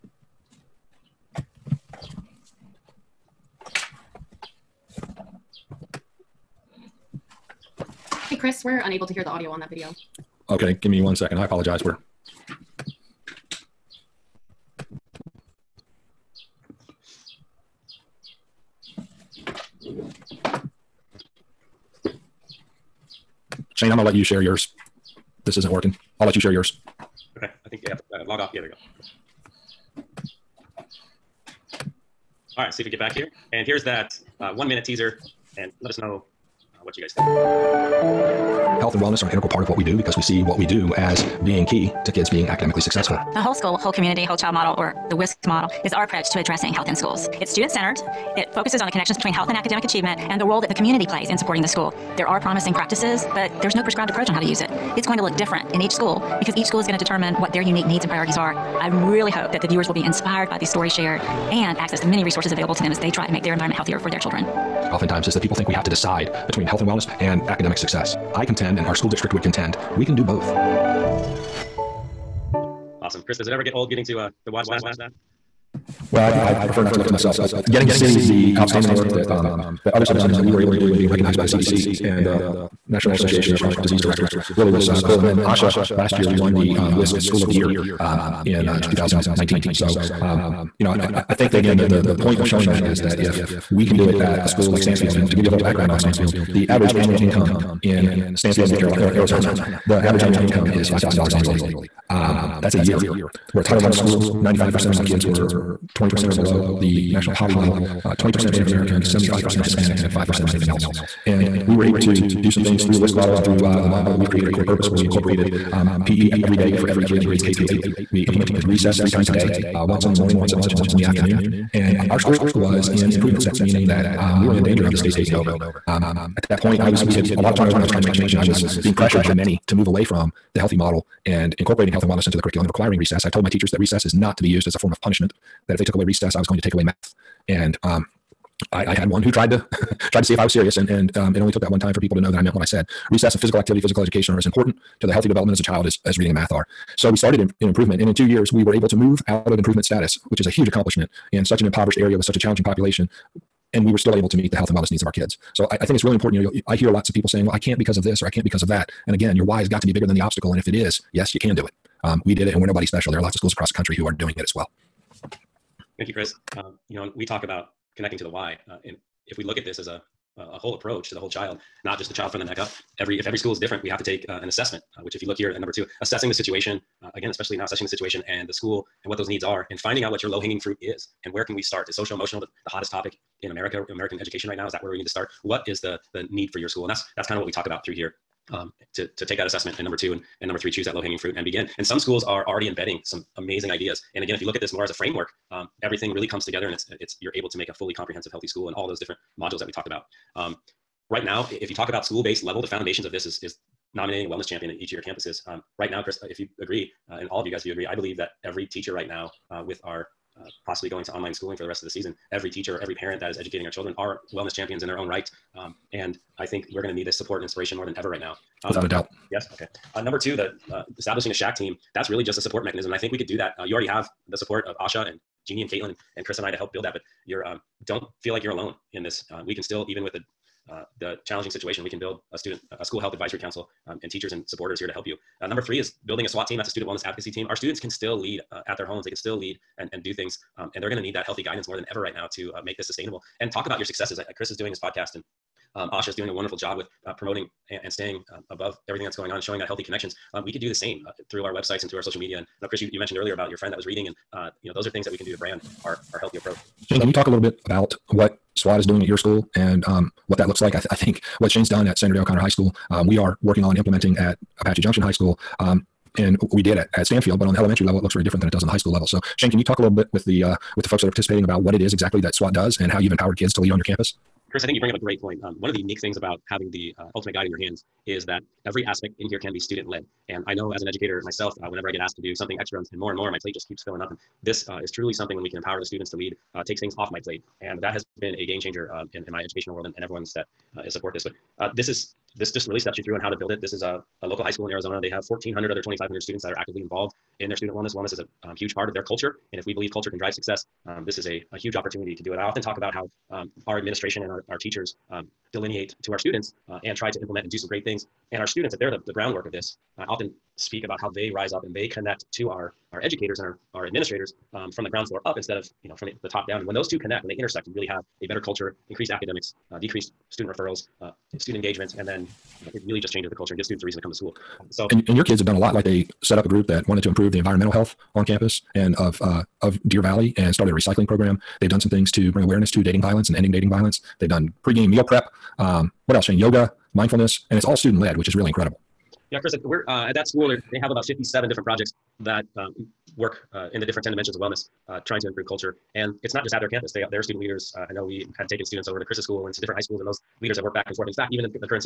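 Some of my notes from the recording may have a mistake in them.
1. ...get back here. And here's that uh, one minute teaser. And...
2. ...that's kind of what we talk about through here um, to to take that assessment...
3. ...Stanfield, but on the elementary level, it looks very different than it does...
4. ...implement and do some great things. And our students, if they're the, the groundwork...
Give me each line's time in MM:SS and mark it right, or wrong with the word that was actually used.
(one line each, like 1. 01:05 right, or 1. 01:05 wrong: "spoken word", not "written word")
1. 00:32 right
2. 03:07 right
3. 04:27 right
4. 05:07 right.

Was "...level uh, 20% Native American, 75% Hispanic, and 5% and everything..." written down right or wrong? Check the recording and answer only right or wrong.
right.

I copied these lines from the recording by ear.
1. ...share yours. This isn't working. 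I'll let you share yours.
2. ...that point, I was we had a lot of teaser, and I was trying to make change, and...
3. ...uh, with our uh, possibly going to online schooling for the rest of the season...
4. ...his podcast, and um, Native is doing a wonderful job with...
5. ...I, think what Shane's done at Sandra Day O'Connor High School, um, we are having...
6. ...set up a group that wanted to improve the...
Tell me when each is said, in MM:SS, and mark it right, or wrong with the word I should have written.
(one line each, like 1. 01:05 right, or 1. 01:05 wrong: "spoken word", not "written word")
1. 00:24 right
2. 02:06 wrong: "turnover", not "teaser"
3. 03:29 right
4. 04:04 wrong: "ASHA", not "Native"
5. 04:20 wrong: "working", not "having"
6. 05:26 right.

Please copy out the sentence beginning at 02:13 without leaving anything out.
I've told my teachers that recess is not to be used as a form of punishment.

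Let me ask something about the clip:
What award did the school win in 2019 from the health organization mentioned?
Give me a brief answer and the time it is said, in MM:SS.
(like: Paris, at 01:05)
WSCC School of the Year, at 01:26.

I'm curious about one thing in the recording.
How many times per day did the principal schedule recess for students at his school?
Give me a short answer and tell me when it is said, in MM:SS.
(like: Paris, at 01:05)
3, at 01:59.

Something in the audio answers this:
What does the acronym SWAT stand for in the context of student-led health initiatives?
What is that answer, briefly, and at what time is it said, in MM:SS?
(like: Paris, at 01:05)
Student wellness advocacy team, at 03:56.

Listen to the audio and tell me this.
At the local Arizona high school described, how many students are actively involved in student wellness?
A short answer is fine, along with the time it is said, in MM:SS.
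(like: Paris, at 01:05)
1,400, at 04:55.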